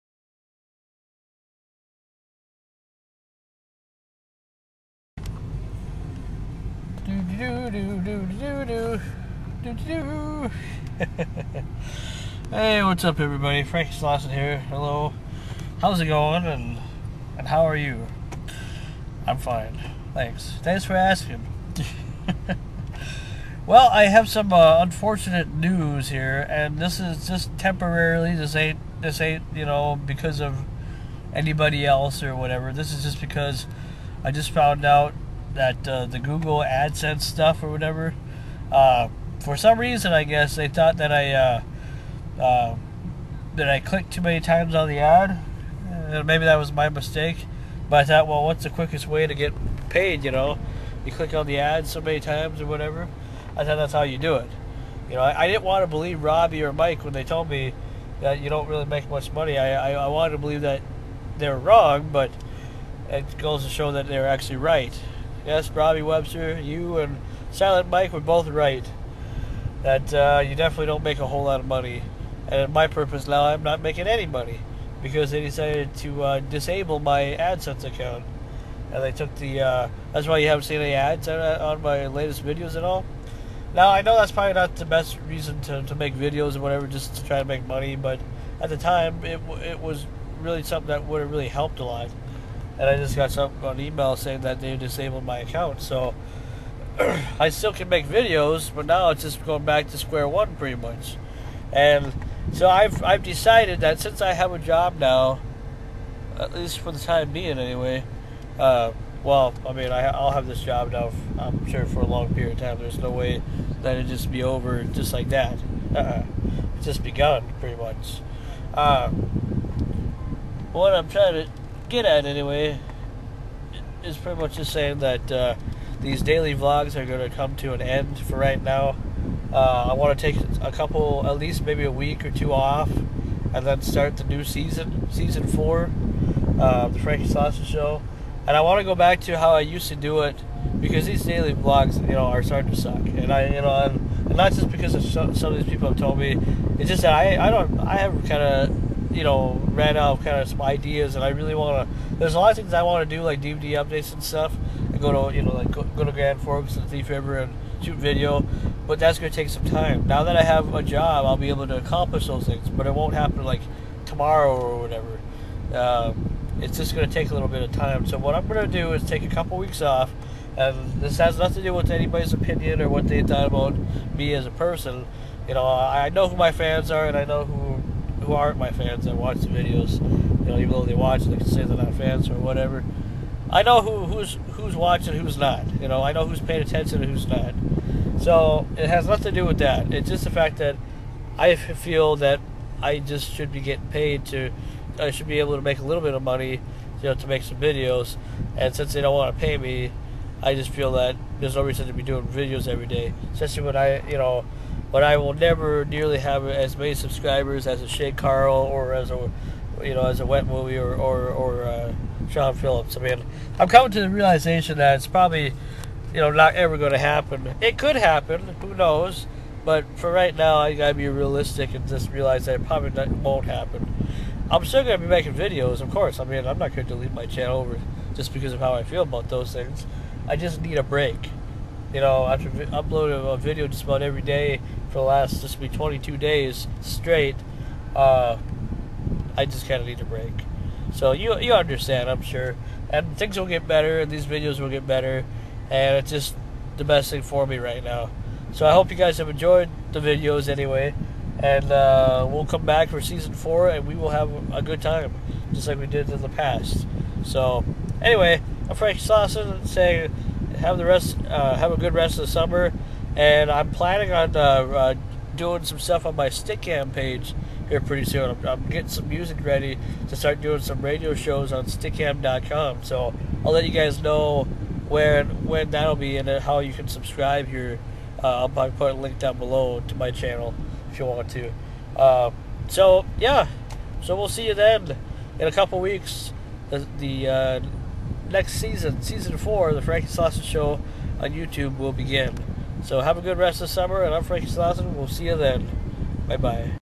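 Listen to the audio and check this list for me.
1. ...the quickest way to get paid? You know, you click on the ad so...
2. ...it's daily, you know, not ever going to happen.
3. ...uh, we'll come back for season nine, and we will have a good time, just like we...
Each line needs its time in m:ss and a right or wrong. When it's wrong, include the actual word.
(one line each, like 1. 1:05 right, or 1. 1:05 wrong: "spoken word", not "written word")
1. 0:48 right
2. 3:34 wrong: "probably", not "daily"
3. 4:11 wrong: "four", not "nine".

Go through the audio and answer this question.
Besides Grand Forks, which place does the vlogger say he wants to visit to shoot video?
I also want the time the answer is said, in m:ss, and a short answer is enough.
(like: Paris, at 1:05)
Thief River, at 2:36.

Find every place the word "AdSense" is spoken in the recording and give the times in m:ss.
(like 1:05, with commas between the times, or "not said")
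0:36, 1:17.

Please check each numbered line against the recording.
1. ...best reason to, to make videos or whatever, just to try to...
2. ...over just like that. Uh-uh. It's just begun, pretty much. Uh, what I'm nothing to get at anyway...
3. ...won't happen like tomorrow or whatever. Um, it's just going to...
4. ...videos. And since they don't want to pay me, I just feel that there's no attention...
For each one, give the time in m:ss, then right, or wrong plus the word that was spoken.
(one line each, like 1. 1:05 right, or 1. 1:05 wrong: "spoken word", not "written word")
1. 1:24 right
2. 1:54 wrong: "trying", not "nothing"
3. 2:42 right
4. 3:17 wrong: "reason", not "attention".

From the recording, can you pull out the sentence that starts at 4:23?
And I'm planning on uh, uh, doing some stuff on my Stickam page here pretty soon.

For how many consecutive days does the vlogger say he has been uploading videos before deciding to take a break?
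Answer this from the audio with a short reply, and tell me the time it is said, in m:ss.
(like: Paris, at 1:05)
22, at 3:55.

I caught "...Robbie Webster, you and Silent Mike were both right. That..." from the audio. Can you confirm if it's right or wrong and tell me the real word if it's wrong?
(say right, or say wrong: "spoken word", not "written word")
right.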